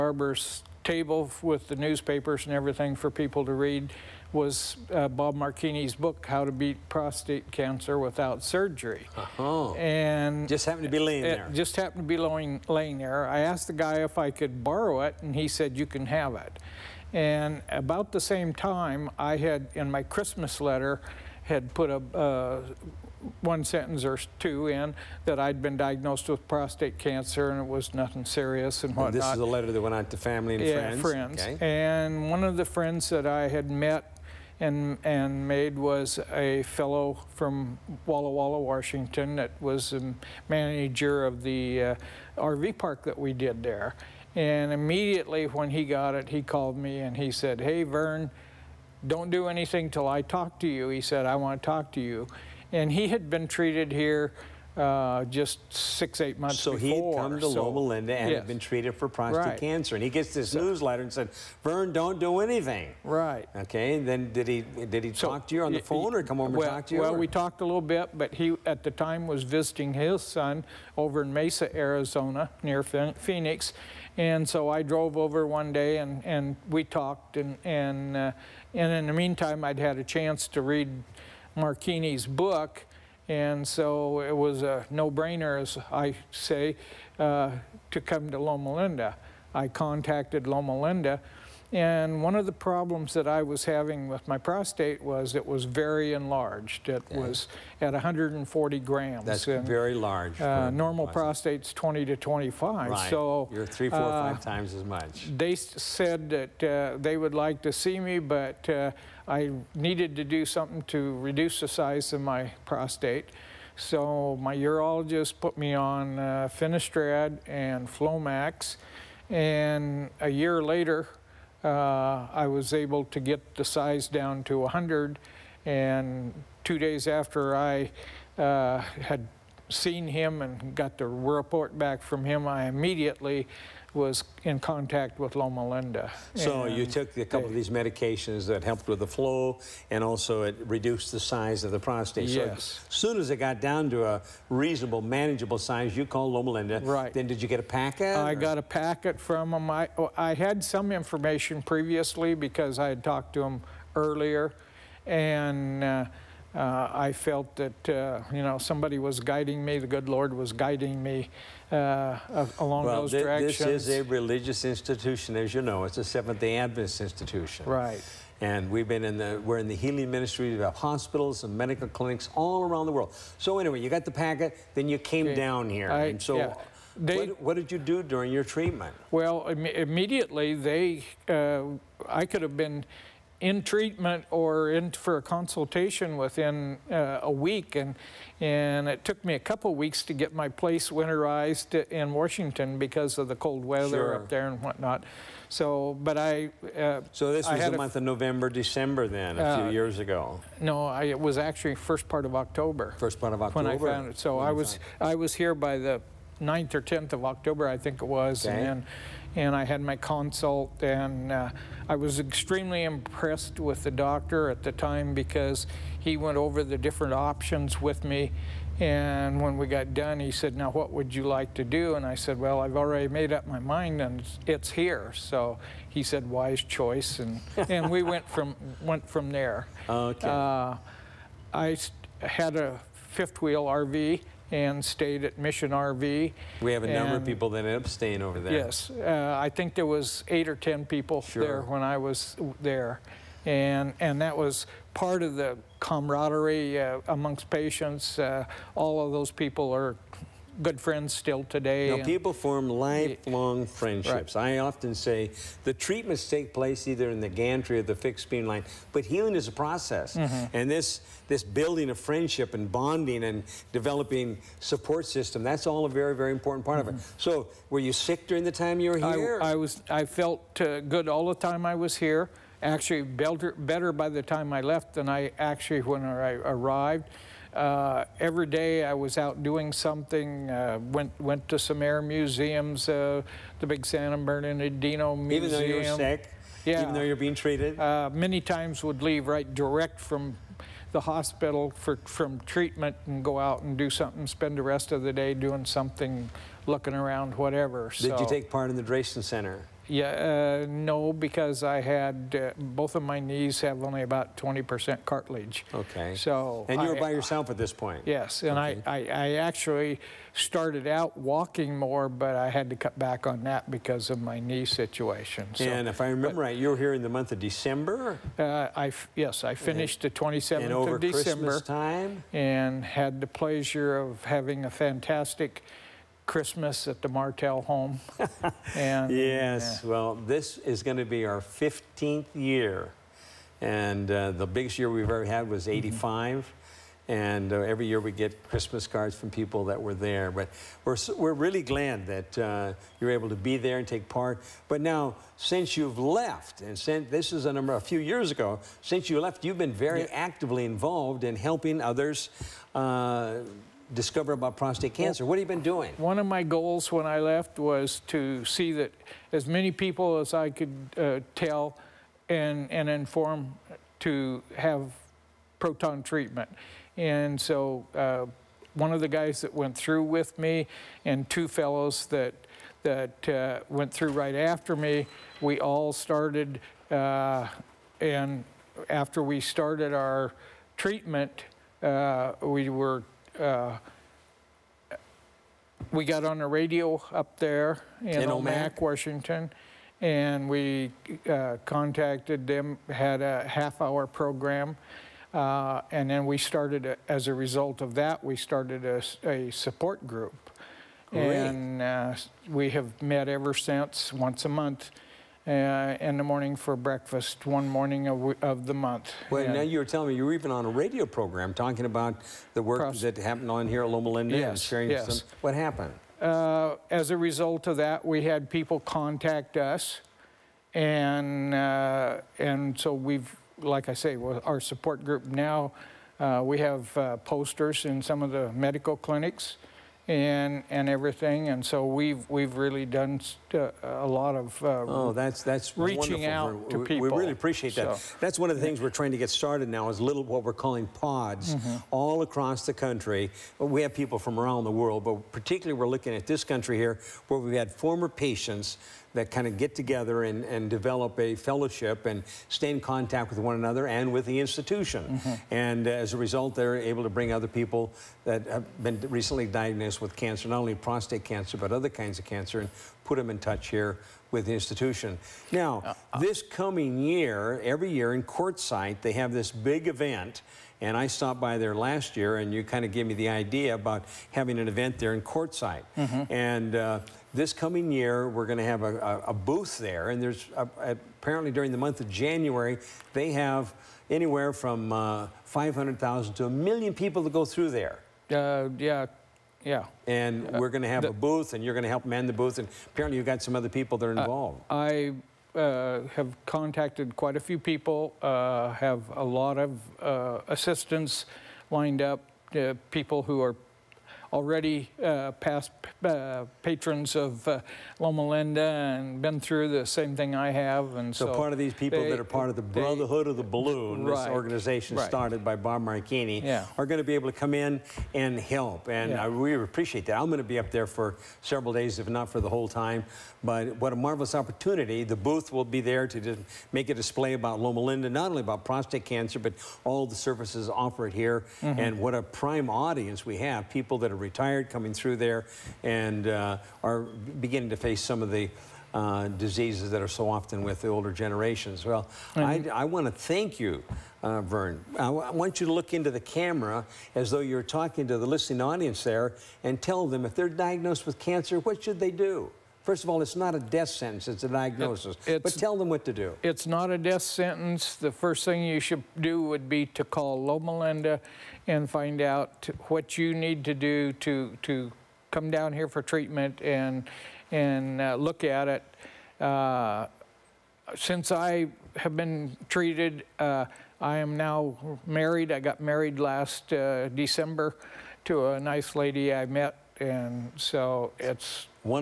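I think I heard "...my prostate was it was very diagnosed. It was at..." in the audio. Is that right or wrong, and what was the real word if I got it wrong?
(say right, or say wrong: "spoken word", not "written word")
wrong: "enlarged", not "diagnosed".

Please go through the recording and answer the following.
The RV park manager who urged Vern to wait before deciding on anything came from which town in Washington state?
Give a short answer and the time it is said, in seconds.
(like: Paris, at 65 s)
Walla Walla, at 38 s.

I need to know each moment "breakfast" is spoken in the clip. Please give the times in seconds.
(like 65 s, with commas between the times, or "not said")
406 s.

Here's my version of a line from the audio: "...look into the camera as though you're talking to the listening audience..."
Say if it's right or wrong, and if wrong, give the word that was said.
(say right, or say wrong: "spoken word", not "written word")
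right.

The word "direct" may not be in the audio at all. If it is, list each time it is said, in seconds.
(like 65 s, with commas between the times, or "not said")
289 s.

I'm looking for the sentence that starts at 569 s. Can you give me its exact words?
Uh, since I have been treated, uh, I am now married.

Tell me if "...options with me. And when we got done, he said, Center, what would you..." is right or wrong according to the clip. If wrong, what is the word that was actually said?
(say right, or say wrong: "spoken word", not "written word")
wrong: "Now", not "Center".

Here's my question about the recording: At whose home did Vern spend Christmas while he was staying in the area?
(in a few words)
The Martell home.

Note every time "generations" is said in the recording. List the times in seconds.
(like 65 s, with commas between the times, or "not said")
541 s.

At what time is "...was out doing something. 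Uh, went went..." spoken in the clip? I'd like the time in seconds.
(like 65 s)
278 s.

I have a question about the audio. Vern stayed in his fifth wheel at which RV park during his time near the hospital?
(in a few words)
Mission RV.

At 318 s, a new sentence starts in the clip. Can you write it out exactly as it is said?
Uh, I yes, I finished and, the 27th and over of December.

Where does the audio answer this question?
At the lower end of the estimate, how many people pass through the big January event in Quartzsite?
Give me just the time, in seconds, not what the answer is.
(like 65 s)
485 s.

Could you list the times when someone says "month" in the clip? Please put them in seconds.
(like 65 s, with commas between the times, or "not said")
56 s, 197 s, 317 s, 404 s, 408 s, 481 s.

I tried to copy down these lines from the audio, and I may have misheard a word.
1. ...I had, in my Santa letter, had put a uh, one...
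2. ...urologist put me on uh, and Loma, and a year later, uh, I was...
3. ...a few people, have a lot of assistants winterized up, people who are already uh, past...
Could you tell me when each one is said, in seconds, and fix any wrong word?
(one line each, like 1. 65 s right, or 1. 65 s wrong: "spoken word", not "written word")
1. 19 s wrong: "Christmas", not "Santa"
2. 114 s wrong: "Flomax", not "Loma"
3. 497 s wrong: "lined", not "winterized".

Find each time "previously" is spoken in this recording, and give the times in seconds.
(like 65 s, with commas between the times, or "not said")
151 s.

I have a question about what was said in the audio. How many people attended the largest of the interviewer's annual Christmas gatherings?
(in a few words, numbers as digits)
85.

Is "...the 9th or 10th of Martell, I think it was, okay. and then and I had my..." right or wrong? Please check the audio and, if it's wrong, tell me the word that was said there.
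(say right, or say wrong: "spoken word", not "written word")
wrong: "October", not "Martell".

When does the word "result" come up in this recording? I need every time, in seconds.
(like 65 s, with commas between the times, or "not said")
397 s, 417 s, 456 s.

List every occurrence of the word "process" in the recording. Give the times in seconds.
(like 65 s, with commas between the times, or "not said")
259 s.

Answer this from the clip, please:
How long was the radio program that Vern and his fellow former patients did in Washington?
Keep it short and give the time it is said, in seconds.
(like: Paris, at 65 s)
Half hour, at 393 s.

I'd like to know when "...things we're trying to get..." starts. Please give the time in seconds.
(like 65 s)
438 s.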